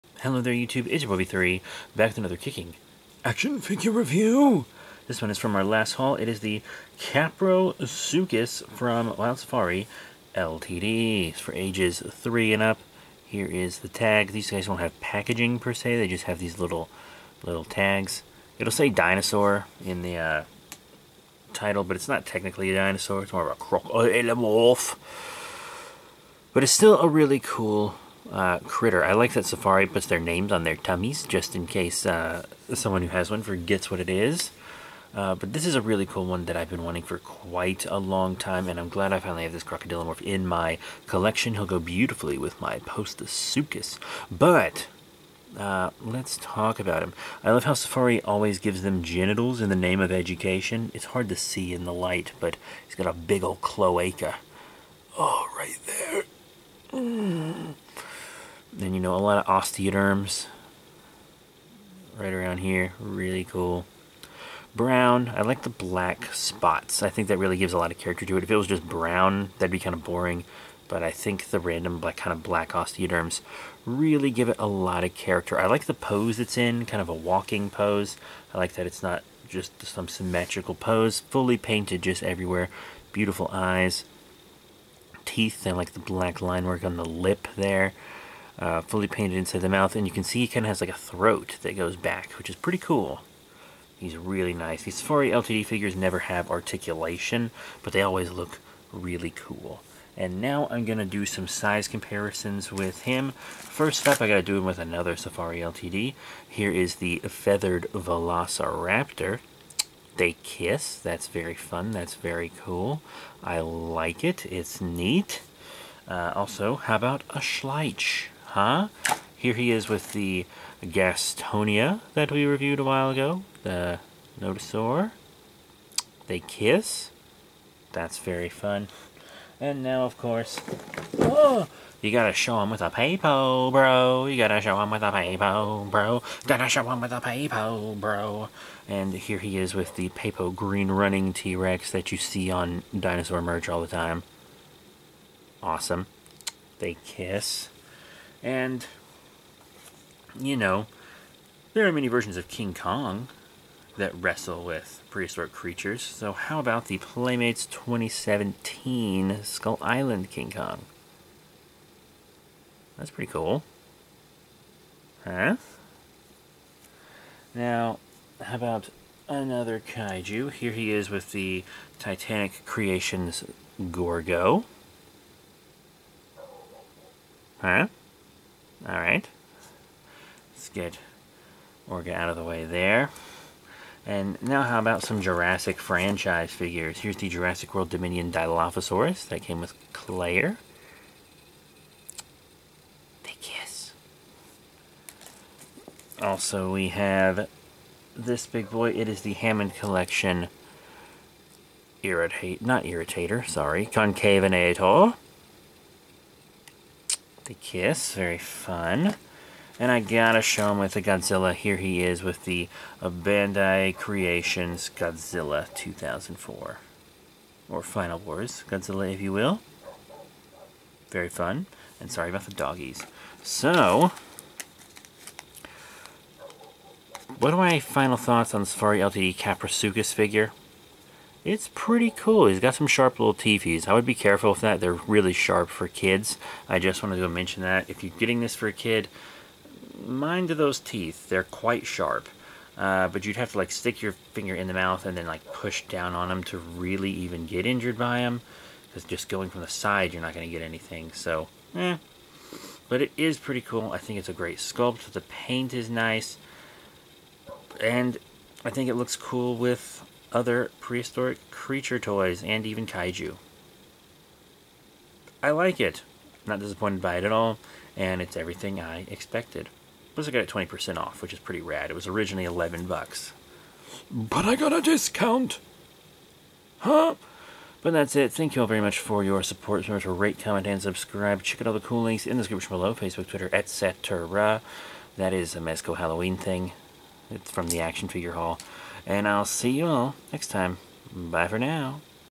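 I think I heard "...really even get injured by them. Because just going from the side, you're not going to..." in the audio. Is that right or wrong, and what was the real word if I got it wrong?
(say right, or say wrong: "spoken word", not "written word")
right.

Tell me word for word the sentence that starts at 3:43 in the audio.
So, what are my final thoughts on the Safari LTD Kaprosuchus figure?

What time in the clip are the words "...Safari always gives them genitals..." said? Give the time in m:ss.
0:47.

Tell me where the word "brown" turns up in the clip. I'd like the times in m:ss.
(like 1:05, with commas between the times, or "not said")
1:04, 1:08.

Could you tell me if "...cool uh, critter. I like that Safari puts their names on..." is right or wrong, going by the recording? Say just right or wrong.
right.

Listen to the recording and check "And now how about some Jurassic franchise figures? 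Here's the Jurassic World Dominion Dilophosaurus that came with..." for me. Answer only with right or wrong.
right.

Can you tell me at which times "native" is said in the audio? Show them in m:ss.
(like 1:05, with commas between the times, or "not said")
not said.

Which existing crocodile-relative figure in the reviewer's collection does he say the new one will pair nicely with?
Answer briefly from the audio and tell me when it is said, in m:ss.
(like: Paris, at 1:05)
Postosuchus, at 0:42.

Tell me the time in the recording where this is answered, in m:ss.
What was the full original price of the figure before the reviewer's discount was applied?
4:32.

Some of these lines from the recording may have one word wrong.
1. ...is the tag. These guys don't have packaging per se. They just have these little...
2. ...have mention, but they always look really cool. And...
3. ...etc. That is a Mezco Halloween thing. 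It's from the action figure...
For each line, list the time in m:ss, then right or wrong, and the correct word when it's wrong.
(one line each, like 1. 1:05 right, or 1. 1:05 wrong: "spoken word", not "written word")
1. 0:13 right
2. 1:36 wrong: "articulation", not "mention"
3. 4:43 right.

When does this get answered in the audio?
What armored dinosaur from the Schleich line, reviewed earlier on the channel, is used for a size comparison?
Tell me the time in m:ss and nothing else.
2:00.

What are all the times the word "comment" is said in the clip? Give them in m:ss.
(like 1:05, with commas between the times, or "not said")
4:40.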